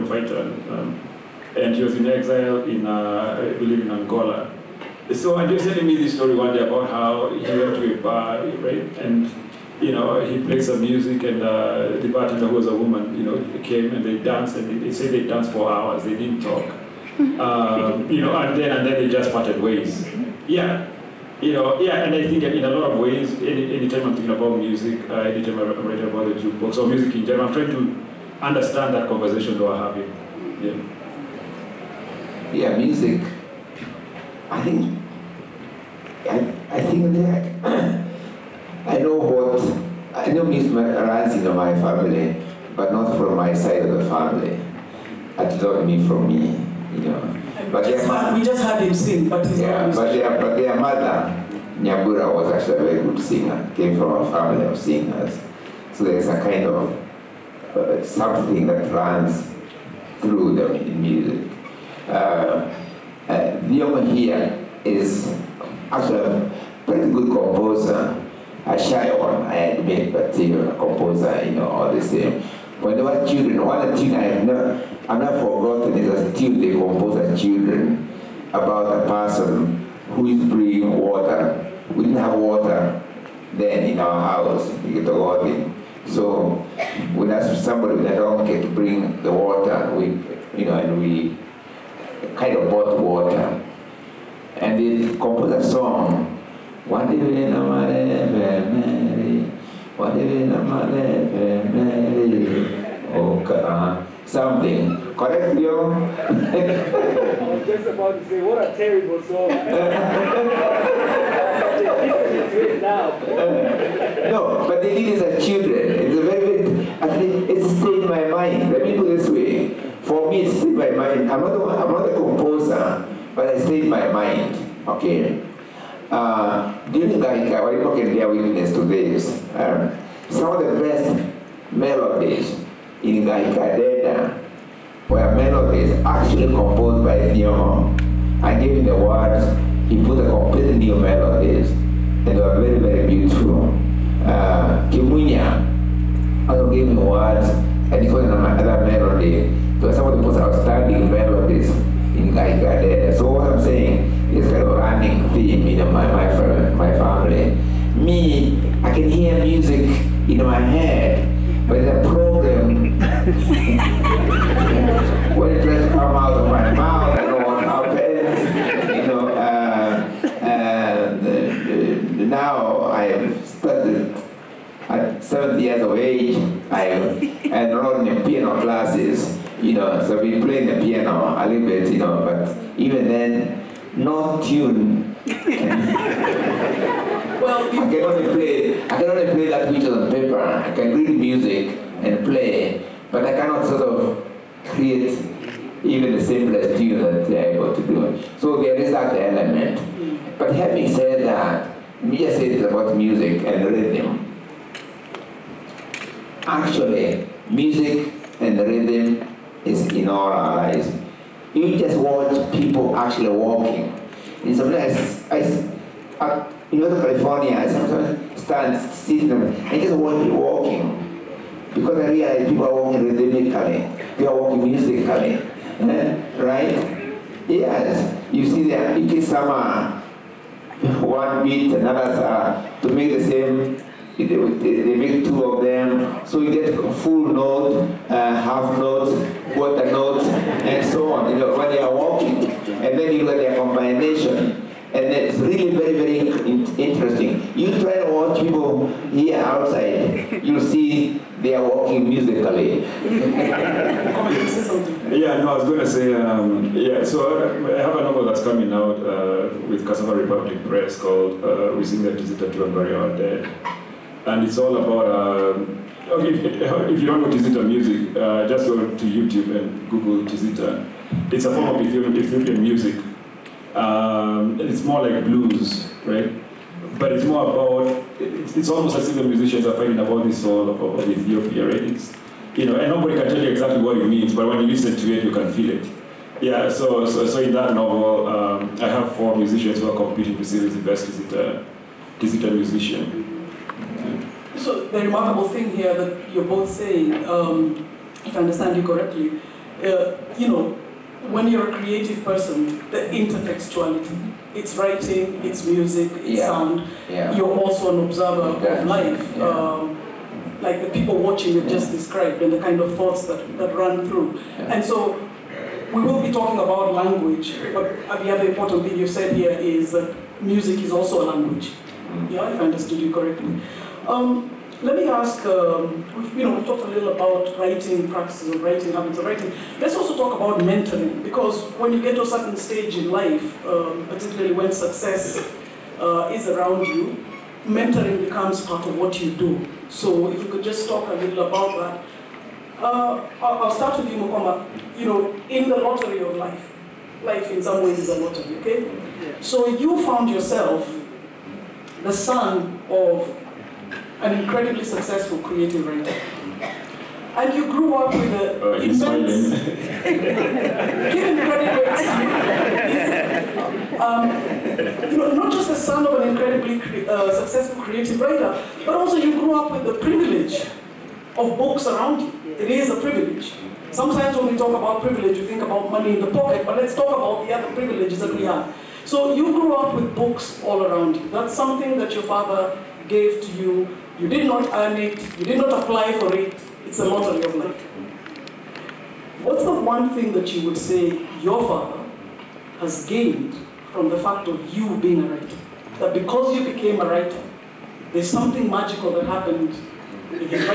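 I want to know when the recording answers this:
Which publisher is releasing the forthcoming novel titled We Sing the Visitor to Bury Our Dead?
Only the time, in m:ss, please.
4:19.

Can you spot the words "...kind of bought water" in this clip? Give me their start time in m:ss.
1:32.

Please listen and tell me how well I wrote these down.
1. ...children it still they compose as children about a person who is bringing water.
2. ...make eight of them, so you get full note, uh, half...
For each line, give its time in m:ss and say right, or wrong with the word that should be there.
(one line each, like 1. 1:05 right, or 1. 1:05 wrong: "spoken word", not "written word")
1. 1:15 wrong: "forgotten", not "children"
2. 3:54 wrong: "two", not "eight".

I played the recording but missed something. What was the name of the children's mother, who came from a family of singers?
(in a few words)
Nyambura.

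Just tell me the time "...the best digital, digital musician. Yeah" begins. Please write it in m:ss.
4:50.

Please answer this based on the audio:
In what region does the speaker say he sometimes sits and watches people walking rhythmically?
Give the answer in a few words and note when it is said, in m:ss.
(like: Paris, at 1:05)
Northern California, at 3:36.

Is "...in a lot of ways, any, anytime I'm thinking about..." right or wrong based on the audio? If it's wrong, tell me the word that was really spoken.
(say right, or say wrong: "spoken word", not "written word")
right.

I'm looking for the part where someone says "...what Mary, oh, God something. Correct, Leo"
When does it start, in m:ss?
1:39.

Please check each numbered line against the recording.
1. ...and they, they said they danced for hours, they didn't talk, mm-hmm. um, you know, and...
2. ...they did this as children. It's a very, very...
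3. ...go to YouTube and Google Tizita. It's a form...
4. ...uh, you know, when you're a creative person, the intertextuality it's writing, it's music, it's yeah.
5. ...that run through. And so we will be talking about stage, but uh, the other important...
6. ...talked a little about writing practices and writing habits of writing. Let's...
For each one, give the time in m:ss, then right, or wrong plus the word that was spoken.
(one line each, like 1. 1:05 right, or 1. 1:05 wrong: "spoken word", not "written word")
1. 0:14 right
2. 1:54 right
3. 4:28 right
4. 4:59 right
5. 5:13 wrong: "language", not "stage"
6. 5:26 right.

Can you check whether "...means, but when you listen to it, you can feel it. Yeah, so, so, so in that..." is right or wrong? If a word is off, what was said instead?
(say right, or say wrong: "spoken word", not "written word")
right.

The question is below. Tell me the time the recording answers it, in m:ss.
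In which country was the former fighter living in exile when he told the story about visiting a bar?
0:03.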